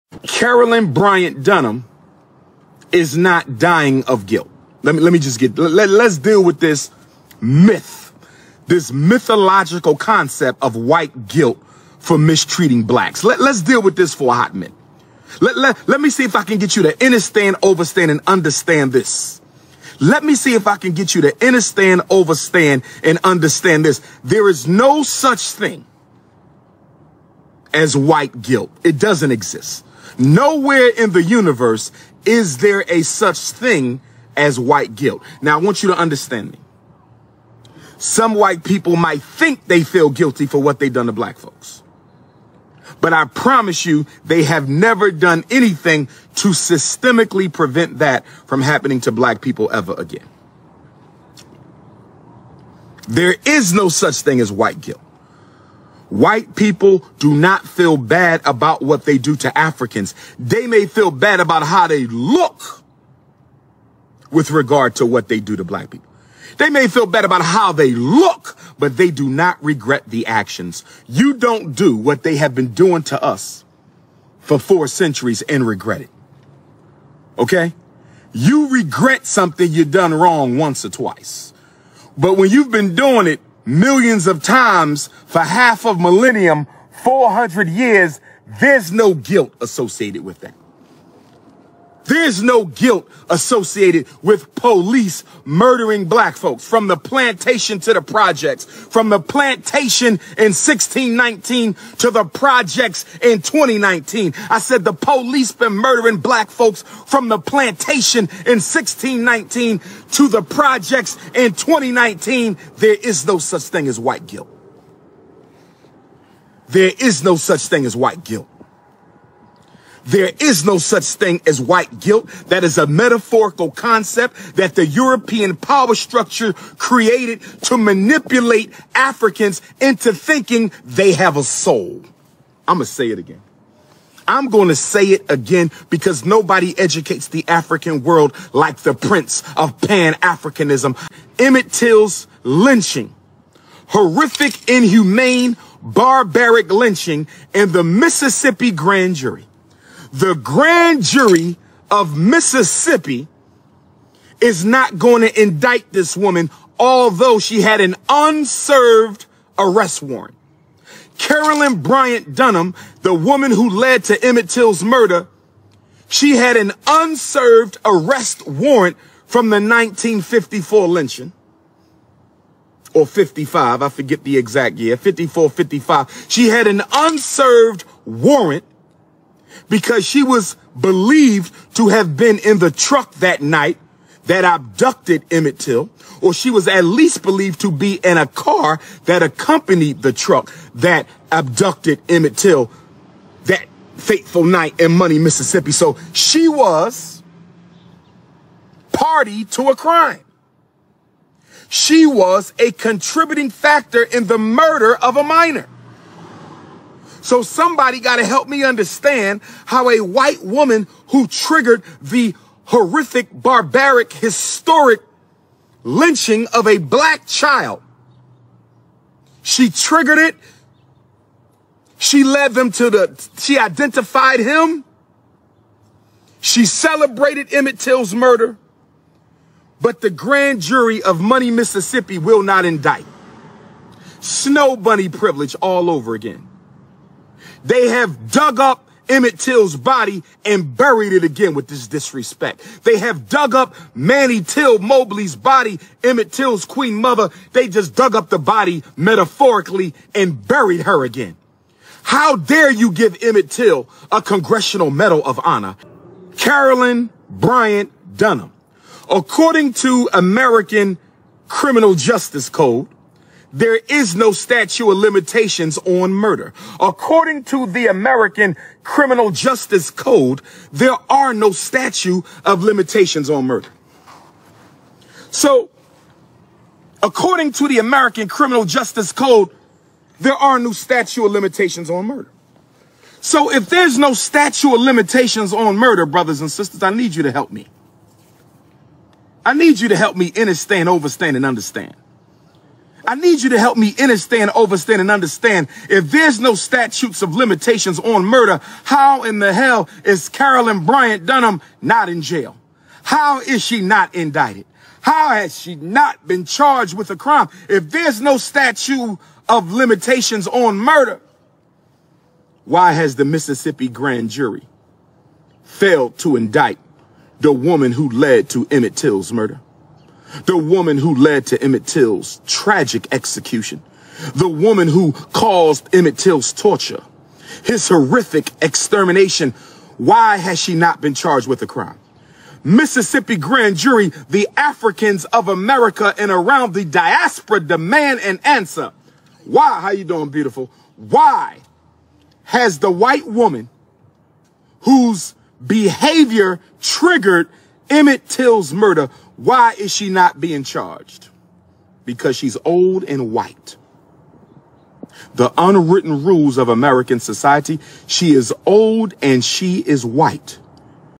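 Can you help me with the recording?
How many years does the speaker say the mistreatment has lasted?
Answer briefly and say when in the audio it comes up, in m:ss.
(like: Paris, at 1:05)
400 years, at 1:27.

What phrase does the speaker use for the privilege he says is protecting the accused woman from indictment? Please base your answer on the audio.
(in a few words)
Snow bunny privilege.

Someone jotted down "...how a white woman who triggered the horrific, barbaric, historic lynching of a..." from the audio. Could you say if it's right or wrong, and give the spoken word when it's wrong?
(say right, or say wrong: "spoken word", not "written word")
right.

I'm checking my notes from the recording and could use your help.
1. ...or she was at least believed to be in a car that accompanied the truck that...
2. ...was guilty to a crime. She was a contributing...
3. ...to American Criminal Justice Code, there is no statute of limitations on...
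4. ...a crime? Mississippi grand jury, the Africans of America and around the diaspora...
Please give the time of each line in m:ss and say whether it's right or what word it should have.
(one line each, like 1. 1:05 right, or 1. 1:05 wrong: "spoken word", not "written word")
1. 3:06 right
2. 3:16 wrong: "party", not "guilty"
3. 4:19 right
4. 5:31 right.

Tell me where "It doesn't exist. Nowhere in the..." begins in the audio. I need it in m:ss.
0:28.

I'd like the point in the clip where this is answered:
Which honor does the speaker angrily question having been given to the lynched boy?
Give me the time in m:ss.
4:14.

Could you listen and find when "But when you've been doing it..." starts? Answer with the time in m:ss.
1:22.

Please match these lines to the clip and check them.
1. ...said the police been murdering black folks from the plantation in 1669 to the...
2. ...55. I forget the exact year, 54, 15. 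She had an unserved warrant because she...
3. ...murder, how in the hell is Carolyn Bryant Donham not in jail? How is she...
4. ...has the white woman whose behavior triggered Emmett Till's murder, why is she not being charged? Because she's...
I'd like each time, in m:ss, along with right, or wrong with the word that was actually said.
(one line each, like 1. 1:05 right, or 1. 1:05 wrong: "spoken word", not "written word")
1. 1:44 wrong: "1619", not "1669"
2. 2:53 wrong: "55", not "15"
3. 4:58 right
4. 5:42 right.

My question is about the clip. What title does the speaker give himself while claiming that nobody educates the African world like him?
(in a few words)
prince of Pan-Africanism.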